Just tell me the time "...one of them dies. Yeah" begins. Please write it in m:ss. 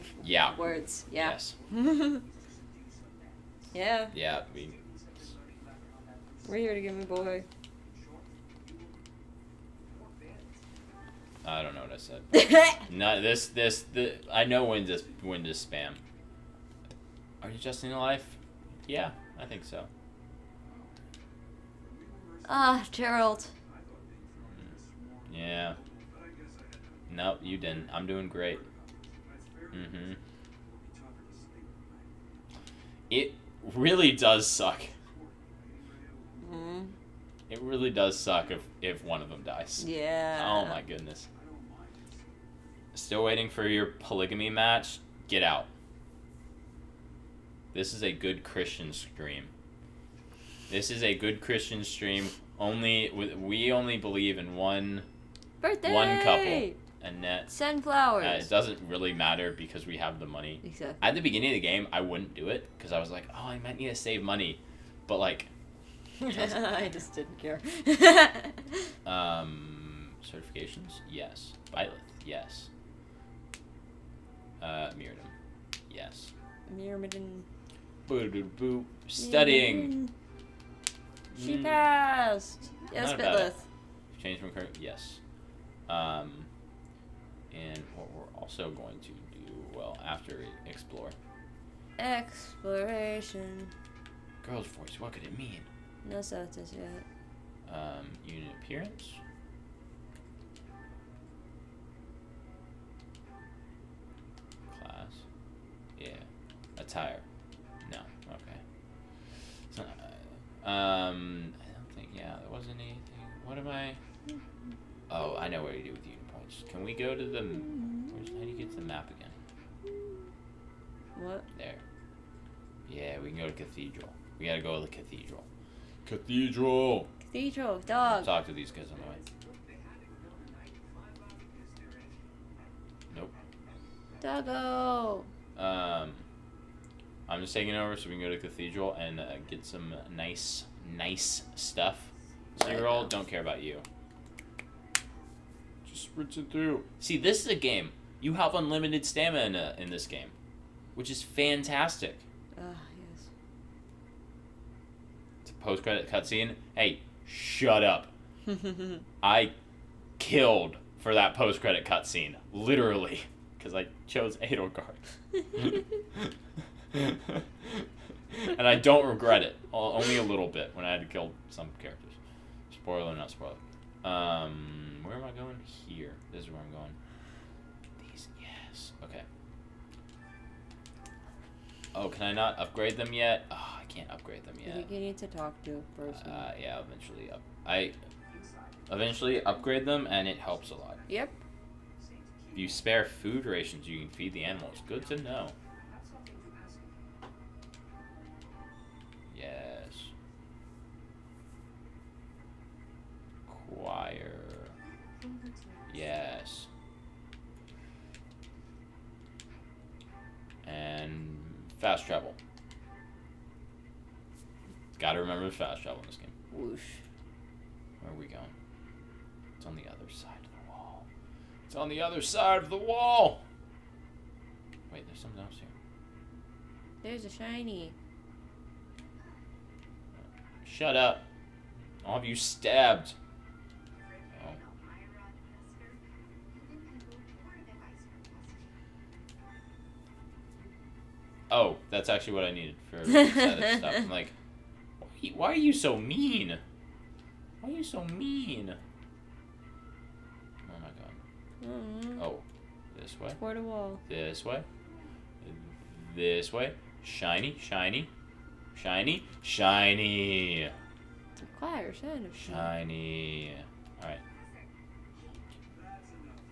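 0:39.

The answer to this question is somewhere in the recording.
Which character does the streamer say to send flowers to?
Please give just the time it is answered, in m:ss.
0:57.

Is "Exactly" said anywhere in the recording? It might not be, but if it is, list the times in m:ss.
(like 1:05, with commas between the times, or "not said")
1:00.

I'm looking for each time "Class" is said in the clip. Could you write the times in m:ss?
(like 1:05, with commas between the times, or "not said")
1:44.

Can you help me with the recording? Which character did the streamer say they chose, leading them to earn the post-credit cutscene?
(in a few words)
Edelgard.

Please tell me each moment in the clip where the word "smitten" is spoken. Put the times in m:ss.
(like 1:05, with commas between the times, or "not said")
not said.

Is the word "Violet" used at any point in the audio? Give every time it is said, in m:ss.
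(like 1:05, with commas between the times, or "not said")
1:11.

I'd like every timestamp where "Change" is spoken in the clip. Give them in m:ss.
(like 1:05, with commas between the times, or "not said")
1:24.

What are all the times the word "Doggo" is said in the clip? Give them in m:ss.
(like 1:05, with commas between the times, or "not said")
2:14.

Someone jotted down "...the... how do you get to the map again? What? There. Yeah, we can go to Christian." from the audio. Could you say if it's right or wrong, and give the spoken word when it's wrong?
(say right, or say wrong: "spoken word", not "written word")
wrong: "Cathedral", not "Christian".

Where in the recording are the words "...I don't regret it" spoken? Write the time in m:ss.
2:48.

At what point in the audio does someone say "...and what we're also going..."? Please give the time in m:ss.
1:27.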